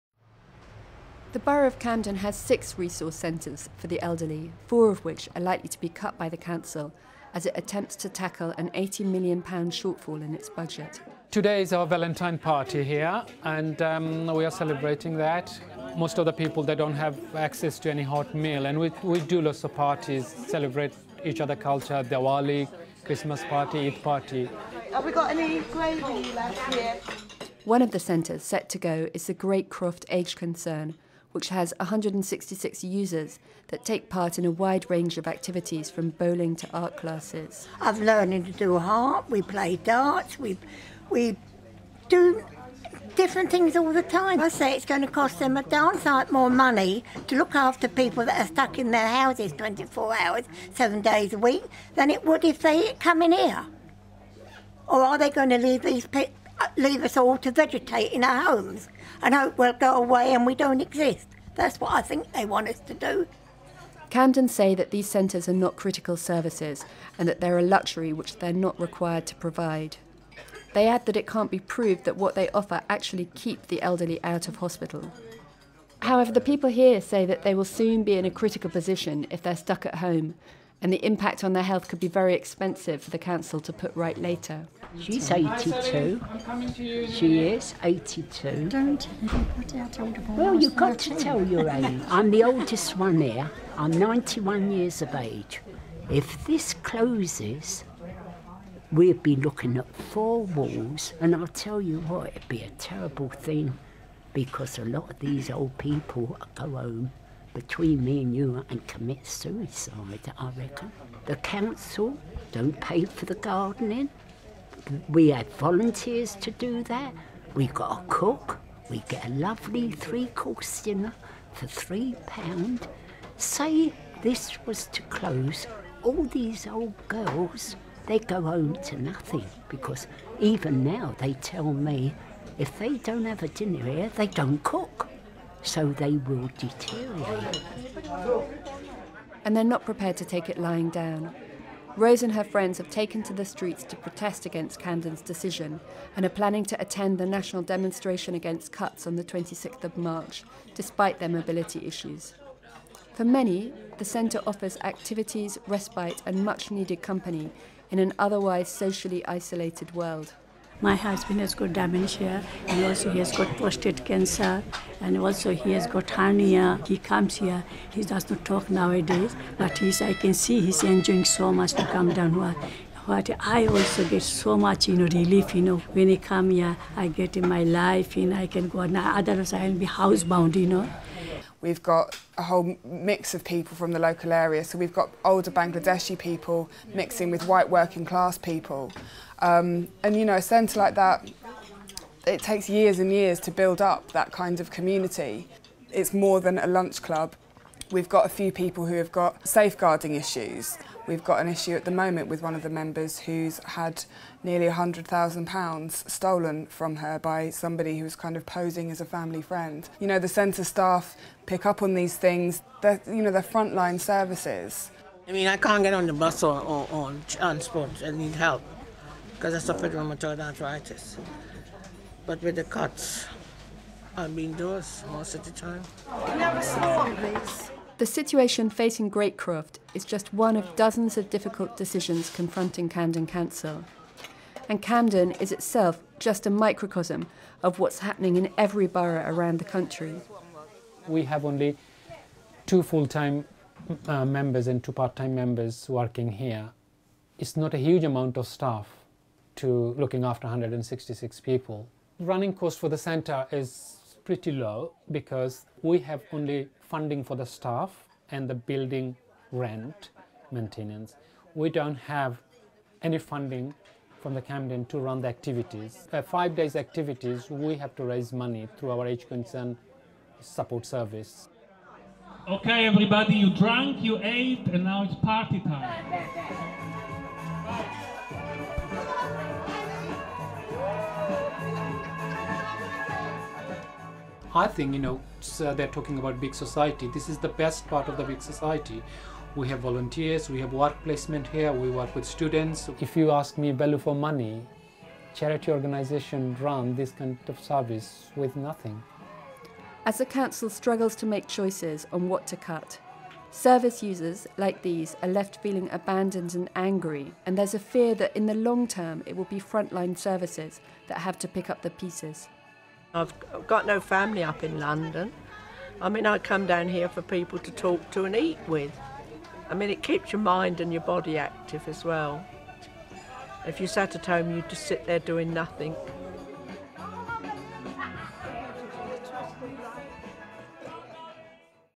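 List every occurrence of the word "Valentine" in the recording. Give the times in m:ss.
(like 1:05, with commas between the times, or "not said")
0:11.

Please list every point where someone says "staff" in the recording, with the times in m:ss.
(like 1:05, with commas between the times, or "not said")
3:30, 4:08, 4:17.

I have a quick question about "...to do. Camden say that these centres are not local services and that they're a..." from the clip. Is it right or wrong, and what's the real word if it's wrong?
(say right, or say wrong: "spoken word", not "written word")
wrong: "critical", not "local".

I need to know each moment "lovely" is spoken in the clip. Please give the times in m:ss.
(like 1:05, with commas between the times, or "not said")
1:59.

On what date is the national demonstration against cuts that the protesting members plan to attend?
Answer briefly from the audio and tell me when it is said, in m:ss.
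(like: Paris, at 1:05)
26th of March, at 2:29.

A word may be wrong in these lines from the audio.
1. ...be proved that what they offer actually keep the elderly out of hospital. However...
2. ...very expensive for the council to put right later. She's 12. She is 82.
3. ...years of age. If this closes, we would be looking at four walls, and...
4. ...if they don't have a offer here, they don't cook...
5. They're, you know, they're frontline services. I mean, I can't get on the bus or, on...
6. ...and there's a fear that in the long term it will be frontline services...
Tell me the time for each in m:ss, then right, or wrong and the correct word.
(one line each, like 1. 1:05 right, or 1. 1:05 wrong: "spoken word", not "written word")
1. 1:11 right
2. 1:22 wrong: "82", not "12"
3. 1:34 right
4. 2:12 wrong: "dinner", not "offer"
5. 3:32 right
6. 5:07 right.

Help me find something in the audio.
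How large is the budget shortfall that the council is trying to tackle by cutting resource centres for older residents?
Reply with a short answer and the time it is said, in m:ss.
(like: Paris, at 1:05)
£80 million, at 0:08.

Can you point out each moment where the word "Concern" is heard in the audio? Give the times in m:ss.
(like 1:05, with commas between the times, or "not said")
0:30, 4:29.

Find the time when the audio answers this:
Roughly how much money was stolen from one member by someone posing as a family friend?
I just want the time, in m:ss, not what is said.
3:24.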